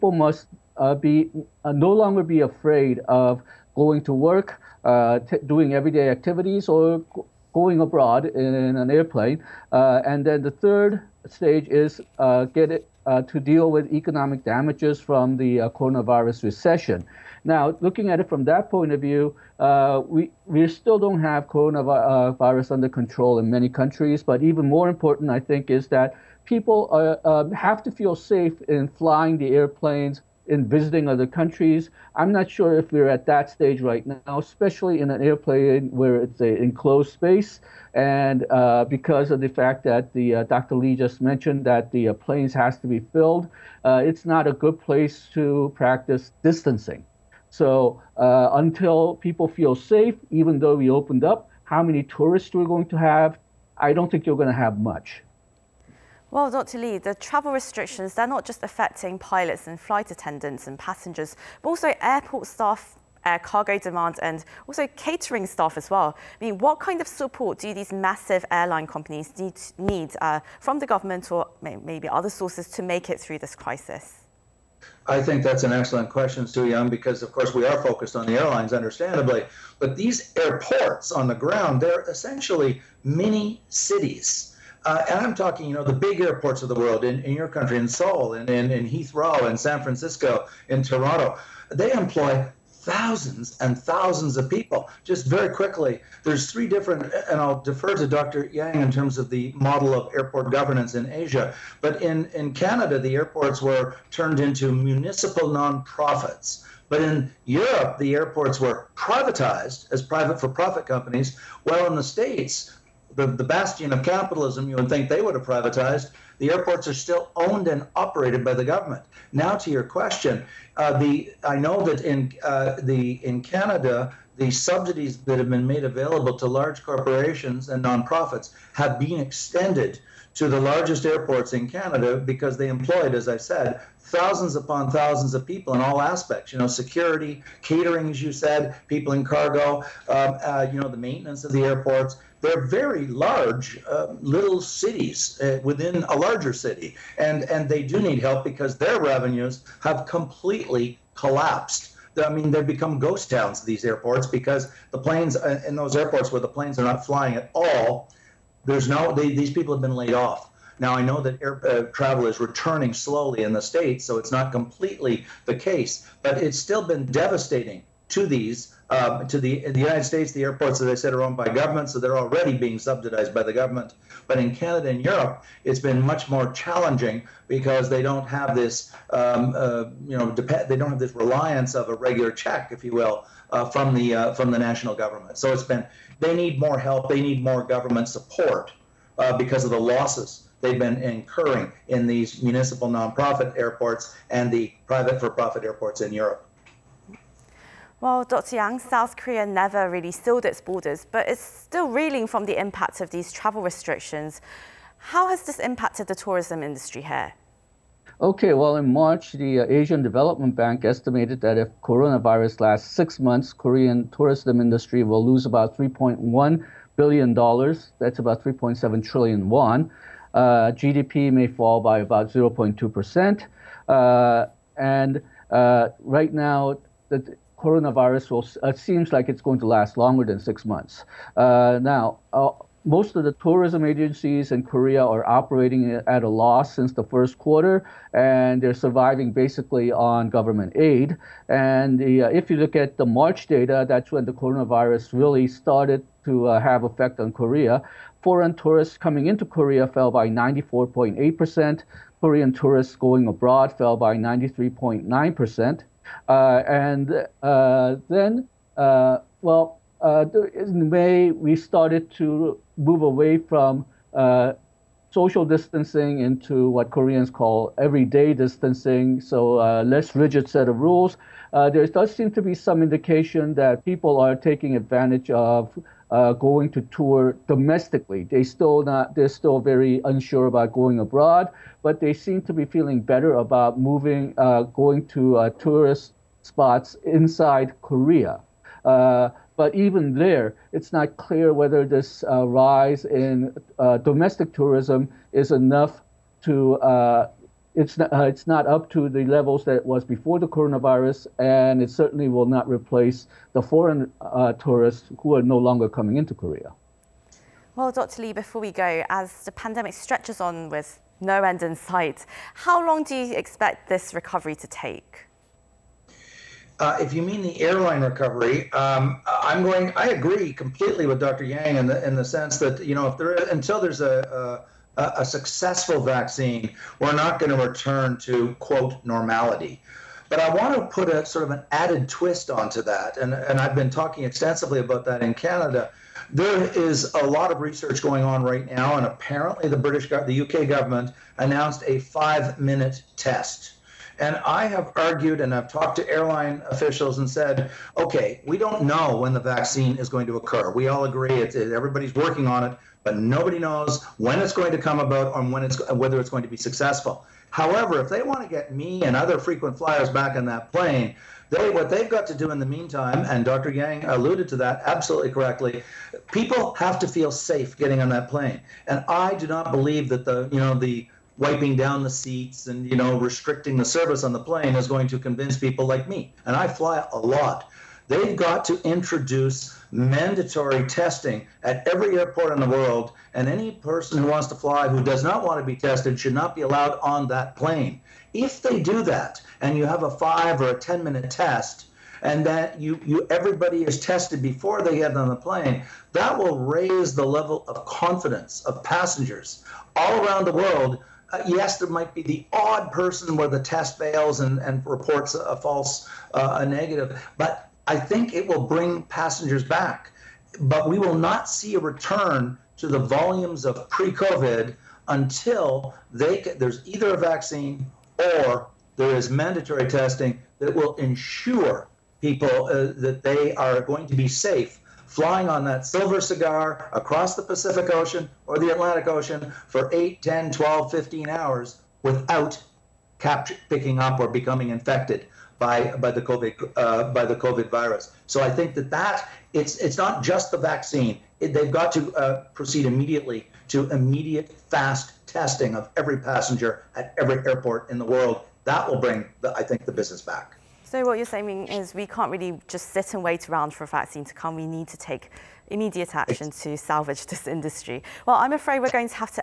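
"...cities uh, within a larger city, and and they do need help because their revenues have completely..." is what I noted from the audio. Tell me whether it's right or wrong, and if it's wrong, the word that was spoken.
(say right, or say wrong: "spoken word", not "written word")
right.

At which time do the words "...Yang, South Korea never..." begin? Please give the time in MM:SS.
03:18.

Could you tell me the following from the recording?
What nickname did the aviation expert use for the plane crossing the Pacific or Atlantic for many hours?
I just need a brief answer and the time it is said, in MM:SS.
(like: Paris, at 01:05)
silver cigar, at 07:05.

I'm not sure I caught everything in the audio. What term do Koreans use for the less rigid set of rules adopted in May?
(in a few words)
everyday distancing.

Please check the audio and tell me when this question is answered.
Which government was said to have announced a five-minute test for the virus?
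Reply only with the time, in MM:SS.
05:40.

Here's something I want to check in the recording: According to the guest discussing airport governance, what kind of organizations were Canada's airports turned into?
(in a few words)
municipal nonprofits.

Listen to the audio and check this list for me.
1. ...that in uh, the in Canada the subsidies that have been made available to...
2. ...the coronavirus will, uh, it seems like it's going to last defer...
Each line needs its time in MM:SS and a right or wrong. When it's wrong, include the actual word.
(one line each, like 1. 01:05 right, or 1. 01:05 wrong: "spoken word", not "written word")
1. 02:01 right
2. 03:47 wrong: "longer", not "defer".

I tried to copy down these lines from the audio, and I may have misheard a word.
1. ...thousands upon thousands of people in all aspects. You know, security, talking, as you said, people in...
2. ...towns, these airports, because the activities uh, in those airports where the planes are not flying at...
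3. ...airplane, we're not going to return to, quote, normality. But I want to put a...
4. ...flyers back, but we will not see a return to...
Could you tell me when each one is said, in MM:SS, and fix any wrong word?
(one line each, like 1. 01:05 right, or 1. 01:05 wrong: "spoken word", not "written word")
1. 02:14 wrong: "catering", not "talking"
2. 02:33 wrong: "planes", not "activities"
3. 05:26 wrong: "vaccine", not "airplane"
4. 06:49 wrong: "passengers", not "flyers".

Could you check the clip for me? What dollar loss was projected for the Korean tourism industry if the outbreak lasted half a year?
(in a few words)
3.1 billion dollars.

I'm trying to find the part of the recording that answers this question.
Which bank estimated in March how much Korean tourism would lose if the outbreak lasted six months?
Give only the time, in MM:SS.
03:29.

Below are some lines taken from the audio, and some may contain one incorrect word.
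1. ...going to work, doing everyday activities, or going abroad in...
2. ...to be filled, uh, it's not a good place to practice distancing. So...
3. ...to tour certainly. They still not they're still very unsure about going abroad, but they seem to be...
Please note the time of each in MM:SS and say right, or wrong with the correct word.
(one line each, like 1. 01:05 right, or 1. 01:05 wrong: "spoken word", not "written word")
1. 00:03 right
2. 00:42 right
3. 04:36 wrong: "domestically", not "certainly".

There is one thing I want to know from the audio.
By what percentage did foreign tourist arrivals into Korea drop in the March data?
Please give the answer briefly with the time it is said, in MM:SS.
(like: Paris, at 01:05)
94.8 percent, at 04:10.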